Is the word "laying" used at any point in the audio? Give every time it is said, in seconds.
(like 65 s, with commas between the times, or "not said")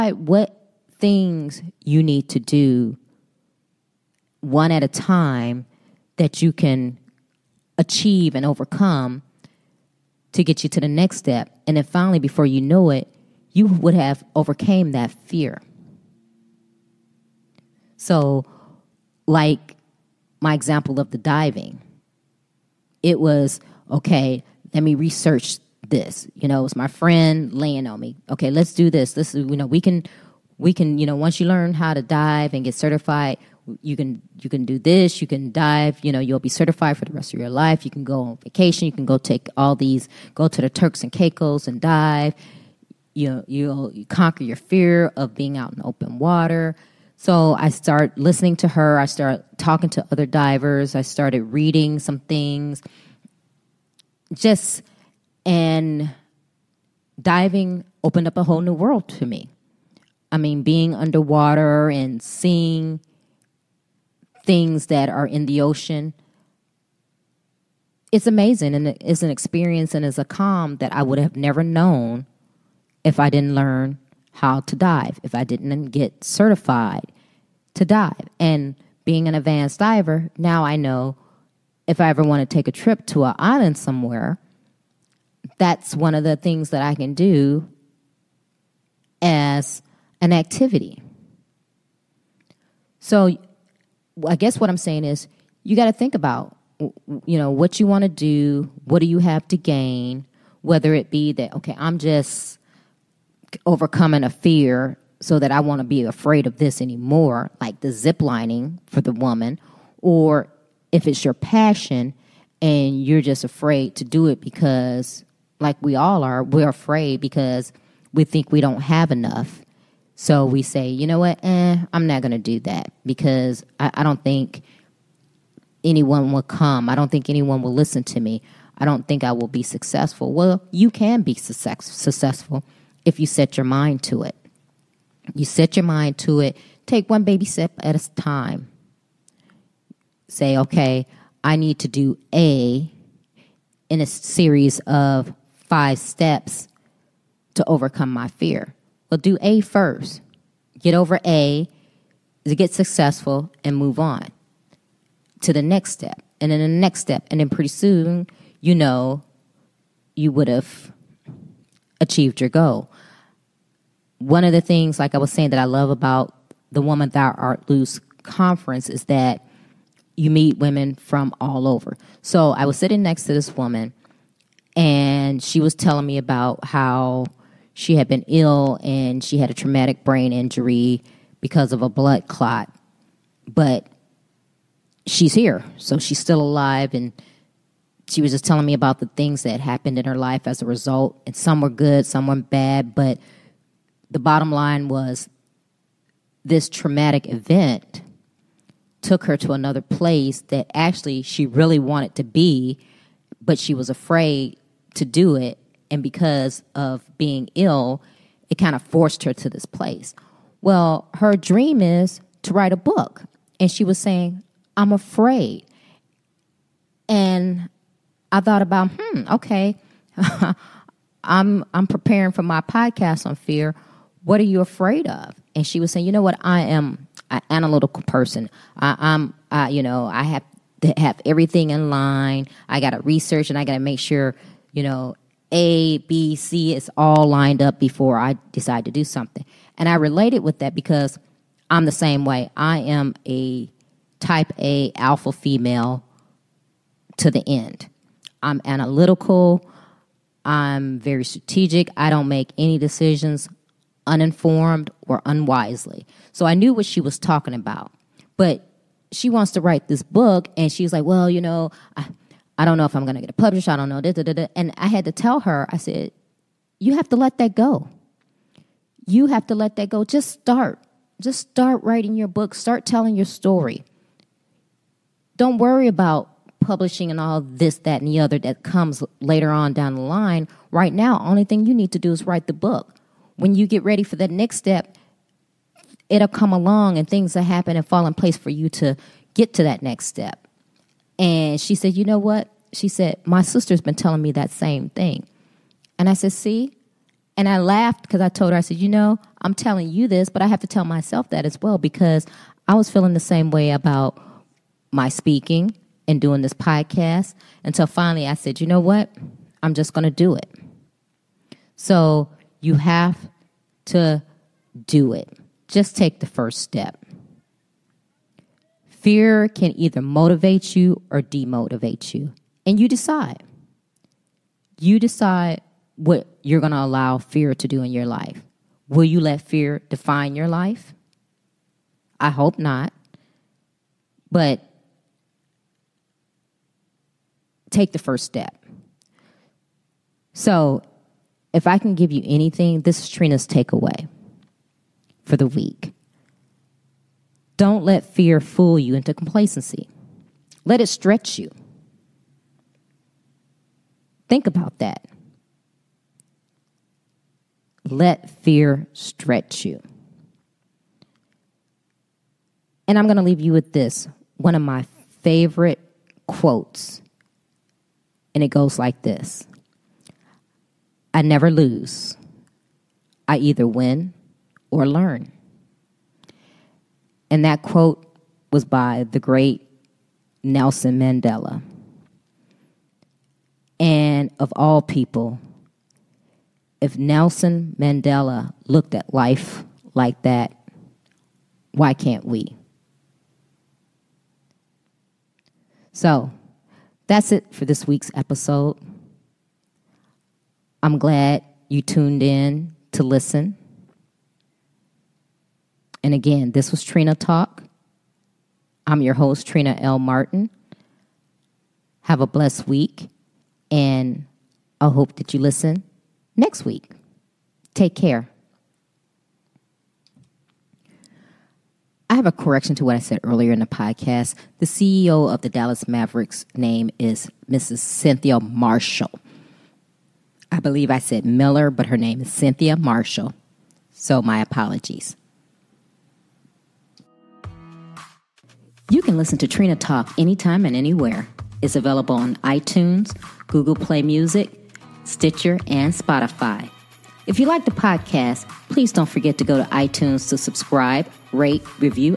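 27 s.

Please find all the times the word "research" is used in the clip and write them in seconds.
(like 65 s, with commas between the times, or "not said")
24 s, 233 s.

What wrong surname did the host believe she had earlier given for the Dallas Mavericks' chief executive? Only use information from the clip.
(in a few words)
Miller.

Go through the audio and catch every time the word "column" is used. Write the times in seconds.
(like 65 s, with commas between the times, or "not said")
not said.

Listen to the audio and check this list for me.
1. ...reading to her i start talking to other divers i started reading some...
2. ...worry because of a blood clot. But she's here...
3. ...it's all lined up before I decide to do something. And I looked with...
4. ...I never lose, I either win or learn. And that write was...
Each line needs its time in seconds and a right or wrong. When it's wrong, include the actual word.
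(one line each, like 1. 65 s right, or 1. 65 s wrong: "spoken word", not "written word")
1. 48 s wrong: "listening", not "reading"
2. 180 s wrong: "injury", not "worry"
3. 236 s wrong: "related", not "looked"
4. 371 s wrong: "quote", not "write".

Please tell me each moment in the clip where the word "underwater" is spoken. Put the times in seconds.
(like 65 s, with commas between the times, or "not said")
60 s.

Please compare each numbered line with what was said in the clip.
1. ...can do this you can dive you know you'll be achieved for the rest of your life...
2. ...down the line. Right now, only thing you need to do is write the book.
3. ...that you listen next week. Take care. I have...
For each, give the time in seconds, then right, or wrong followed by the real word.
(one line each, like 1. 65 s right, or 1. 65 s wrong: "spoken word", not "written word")
1. 34 s wrong: "certified", not "achieved"
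2. 279 s right
3. 415 s right.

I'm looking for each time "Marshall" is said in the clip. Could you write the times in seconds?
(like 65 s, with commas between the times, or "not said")
428 s, 432 s.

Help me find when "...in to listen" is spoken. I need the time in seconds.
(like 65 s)
402 s.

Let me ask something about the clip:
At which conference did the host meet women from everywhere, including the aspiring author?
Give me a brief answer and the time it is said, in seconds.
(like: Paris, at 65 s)
Woman Thou Art Loose, at 166 s.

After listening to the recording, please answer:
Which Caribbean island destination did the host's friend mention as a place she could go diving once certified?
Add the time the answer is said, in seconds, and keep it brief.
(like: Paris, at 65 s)
Turks and Caicos, at 40 s.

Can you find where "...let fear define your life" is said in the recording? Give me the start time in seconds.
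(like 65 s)
329 s.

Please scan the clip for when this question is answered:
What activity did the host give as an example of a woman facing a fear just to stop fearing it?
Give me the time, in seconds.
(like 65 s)
107 s.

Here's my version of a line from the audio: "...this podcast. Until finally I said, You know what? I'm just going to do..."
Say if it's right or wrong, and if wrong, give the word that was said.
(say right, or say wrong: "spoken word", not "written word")
right.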